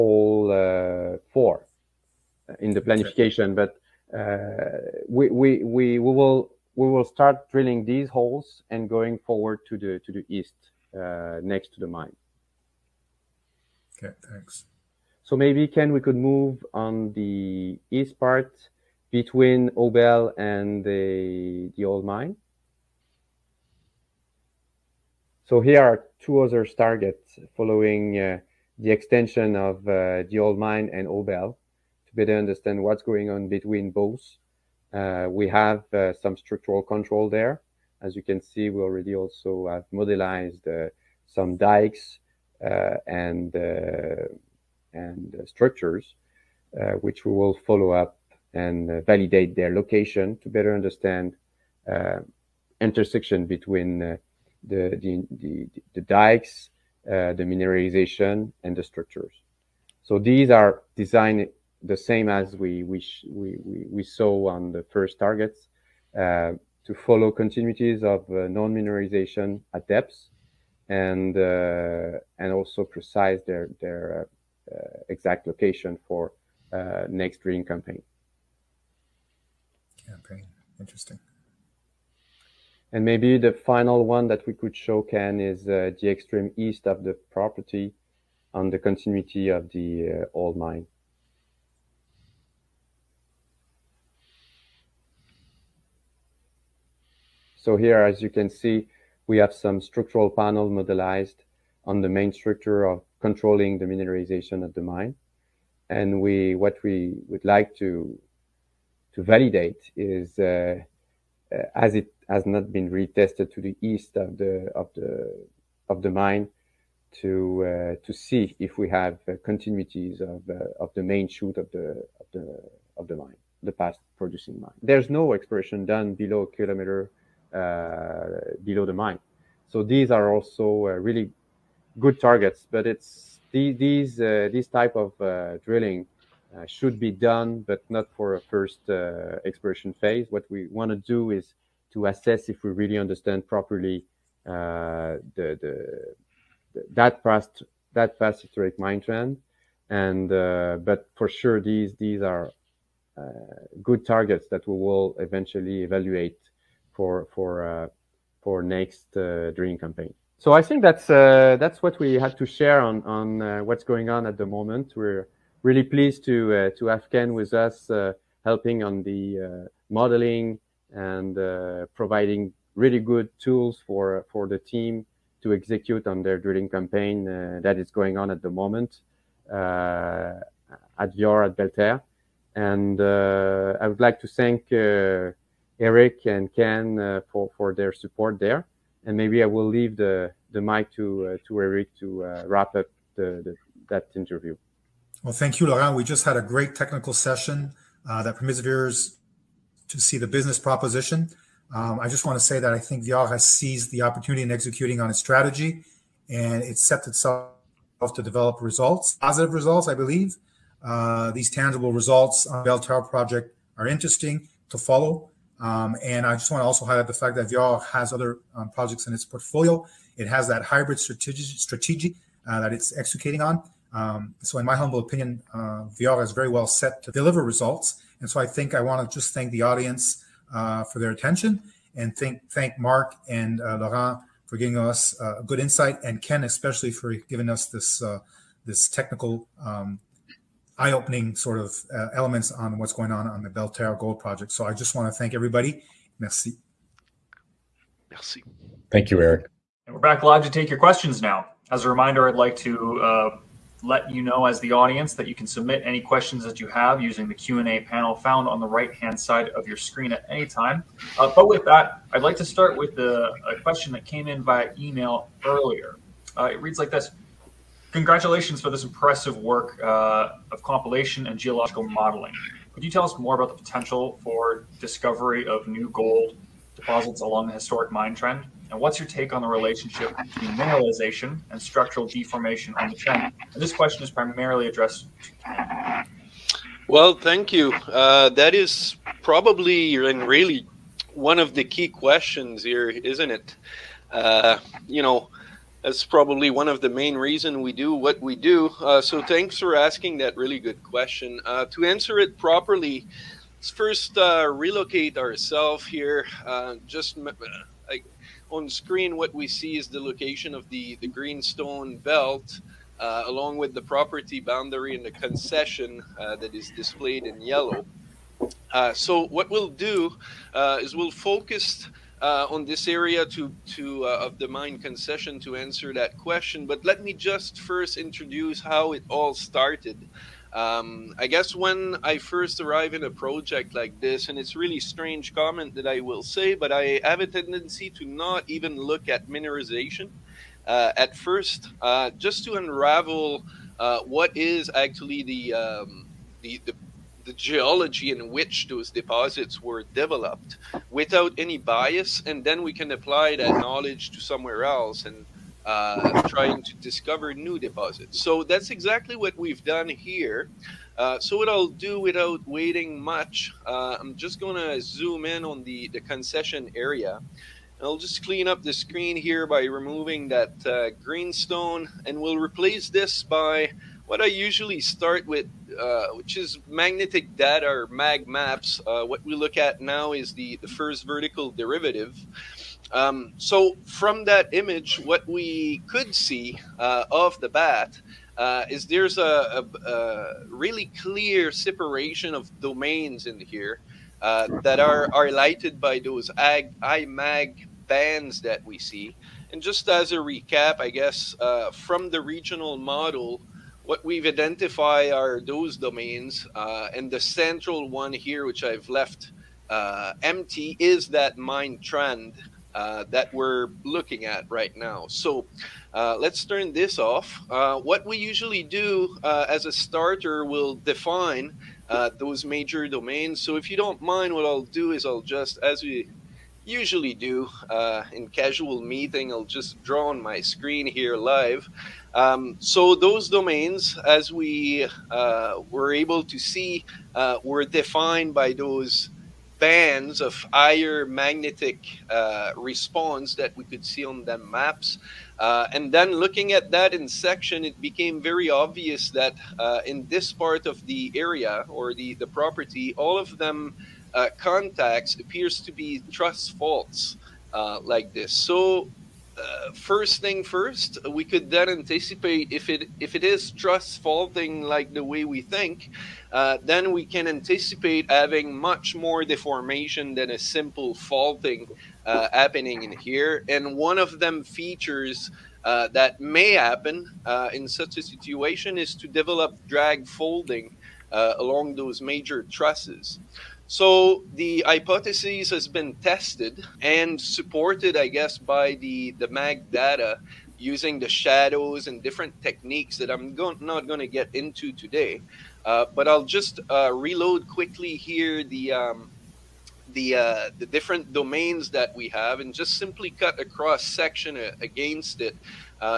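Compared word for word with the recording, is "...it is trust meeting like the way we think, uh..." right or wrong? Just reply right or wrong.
wrong.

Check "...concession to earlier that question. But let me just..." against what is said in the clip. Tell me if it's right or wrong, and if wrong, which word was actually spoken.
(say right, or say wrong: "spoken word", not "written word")
wrong: "answer", not "earlier".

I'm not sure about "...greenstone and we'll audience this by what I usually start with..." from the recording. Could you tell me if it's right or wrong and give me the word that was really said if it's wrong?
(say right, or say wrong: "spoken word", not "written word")
wrong: "replace", not "audience".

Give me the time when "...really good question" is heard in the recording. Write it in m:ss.
5:00.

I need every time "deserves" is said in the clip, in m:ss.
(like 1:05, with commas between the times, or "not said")
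not said.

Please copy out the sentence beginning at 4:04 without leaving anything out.
So I just want to thank everybody.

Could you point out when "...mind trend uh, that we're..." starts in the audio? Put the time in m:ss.
6:51.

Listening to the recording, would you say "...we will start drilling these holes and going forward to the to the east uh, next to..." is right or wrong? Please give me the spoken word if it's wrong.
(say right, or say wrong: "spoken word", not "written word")
right.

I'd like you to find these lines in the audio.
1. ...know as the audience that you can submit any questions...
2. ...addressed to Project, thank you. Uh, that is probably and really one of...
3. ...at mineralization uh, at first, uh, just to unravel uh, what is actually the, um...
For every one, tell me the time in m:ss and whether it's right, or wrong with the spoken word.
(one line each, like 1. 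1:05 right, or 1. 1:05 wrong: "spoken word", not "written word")
1. 4:14 right
2. 4:44 wrong: "Well", not "Project"
3. 5:39 right.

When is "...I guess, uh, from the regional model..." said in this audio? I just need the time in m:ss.
6:40.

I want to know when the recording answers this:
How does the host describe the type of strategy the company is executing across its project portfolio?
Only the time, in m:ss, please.
3:40.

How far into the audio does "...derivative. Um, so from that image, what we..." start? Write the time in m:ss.
6:21.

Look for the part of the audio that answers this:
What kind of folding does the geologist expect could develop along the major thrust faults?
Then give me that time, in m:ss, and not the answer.
7:59.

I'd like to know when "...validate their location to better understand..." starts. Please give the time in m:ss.
0:49.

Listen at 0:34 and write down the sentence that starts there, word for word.
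Uh, we have uh, some structural control there.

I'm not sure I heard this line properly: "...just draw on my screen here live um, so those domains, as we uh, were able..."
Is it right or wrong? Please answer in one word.
right.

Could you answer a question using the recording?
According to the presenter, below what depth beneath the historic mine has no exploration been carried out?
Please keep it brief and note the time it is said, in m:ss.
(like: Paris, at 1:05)
a kilometer, at 2:06.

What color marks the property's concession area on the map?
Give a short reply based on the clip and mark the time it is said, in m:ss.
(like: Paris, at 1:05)
yellow, at 5:17.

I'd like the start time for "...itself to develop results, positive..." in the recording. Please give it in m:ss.
3:27.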